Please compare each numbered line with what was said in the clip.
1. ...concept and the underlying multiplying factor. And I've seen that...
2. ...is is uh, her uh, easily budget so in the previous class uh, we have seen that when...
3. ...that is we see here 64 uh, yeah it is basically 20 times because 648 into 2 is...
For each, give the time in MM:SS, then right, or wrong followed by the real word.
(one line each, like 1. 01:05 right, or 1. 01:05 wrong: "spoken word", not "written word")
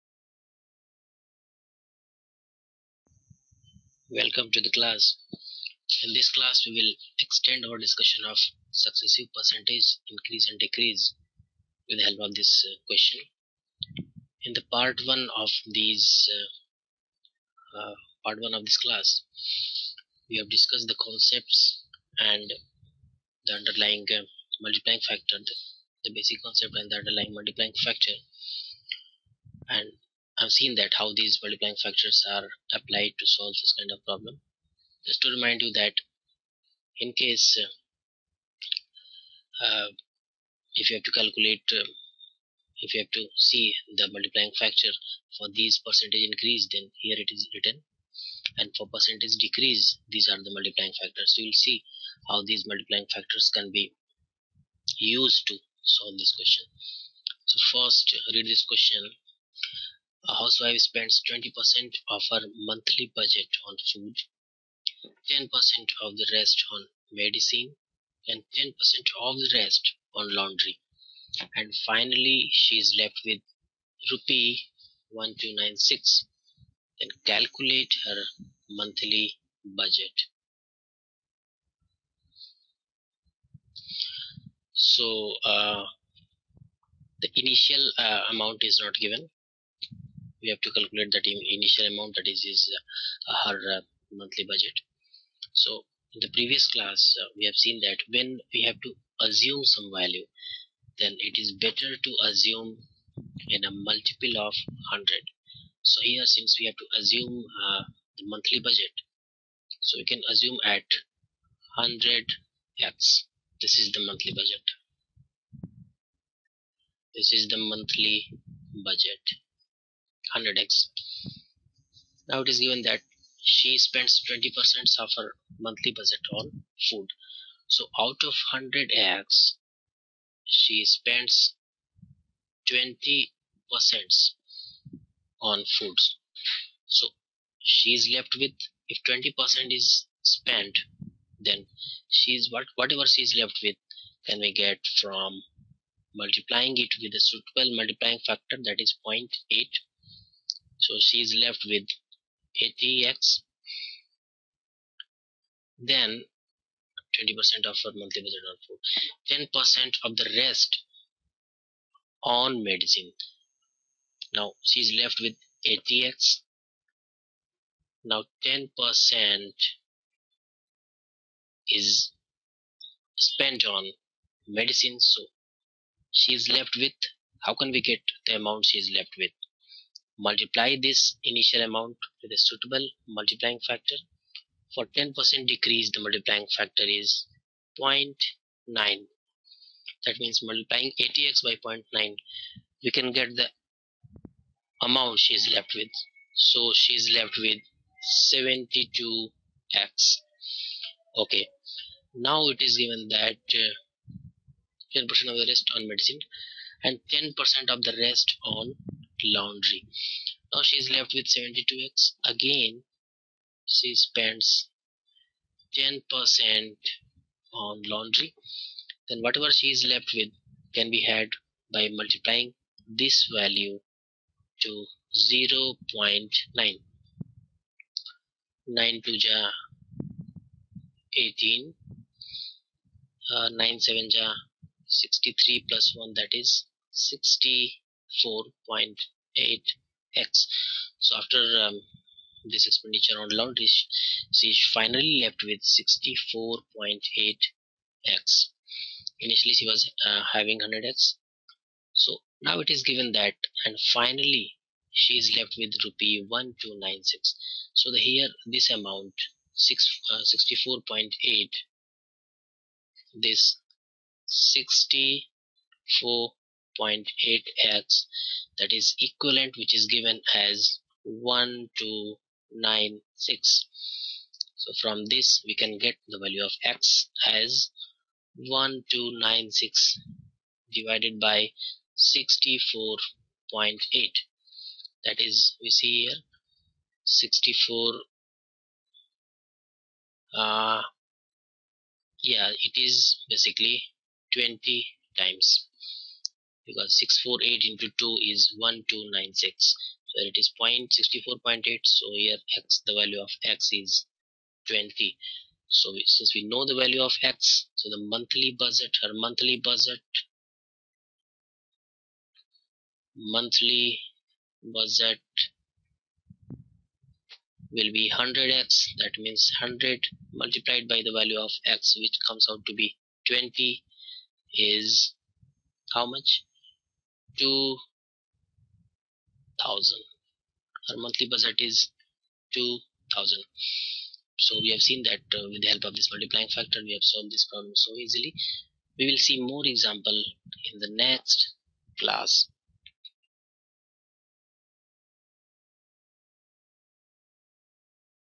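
1. 00:26 right
2. 01:32 wrong: "monthly", not "easily"
3. 04:45 right.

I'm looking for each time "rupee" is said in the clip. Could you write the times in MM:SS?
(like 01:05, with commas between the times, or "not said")
01:14, 04:15.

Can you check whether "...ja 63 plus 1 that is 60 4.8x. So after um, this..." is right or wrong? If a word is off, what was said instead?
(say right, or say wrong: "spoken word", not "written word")
right.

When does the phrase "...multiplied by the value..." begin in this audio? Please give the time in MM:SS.
05:20.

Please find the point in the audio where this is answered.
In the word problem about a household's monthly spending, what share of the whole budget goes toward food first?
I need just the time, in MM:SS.
01:01.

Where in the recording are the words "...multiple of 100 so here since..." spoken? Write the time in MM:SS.
01:43.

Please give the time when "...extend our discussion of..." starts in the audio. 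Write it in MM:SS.
00:07.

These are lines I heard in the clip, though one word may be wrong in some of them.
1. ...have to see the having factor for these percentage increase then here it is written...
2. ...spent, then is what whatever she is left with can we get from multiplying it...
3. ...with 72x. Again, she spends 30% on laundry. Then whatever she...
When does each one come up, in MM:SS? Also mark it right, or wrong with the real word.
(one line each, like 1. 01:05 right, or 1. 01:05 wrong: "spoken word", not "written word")
1. 00:43 wrong: "multiplying", not "having"
2. 02:20 right
3. 03:31 wrong: "10", not "30".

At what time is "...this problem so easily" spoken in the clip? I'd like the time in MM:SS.
05:37.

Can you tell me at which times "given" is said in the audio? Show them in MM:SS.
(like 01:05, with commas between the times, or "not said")
01:28, 02:02, 03:22, 04:12, 04:29.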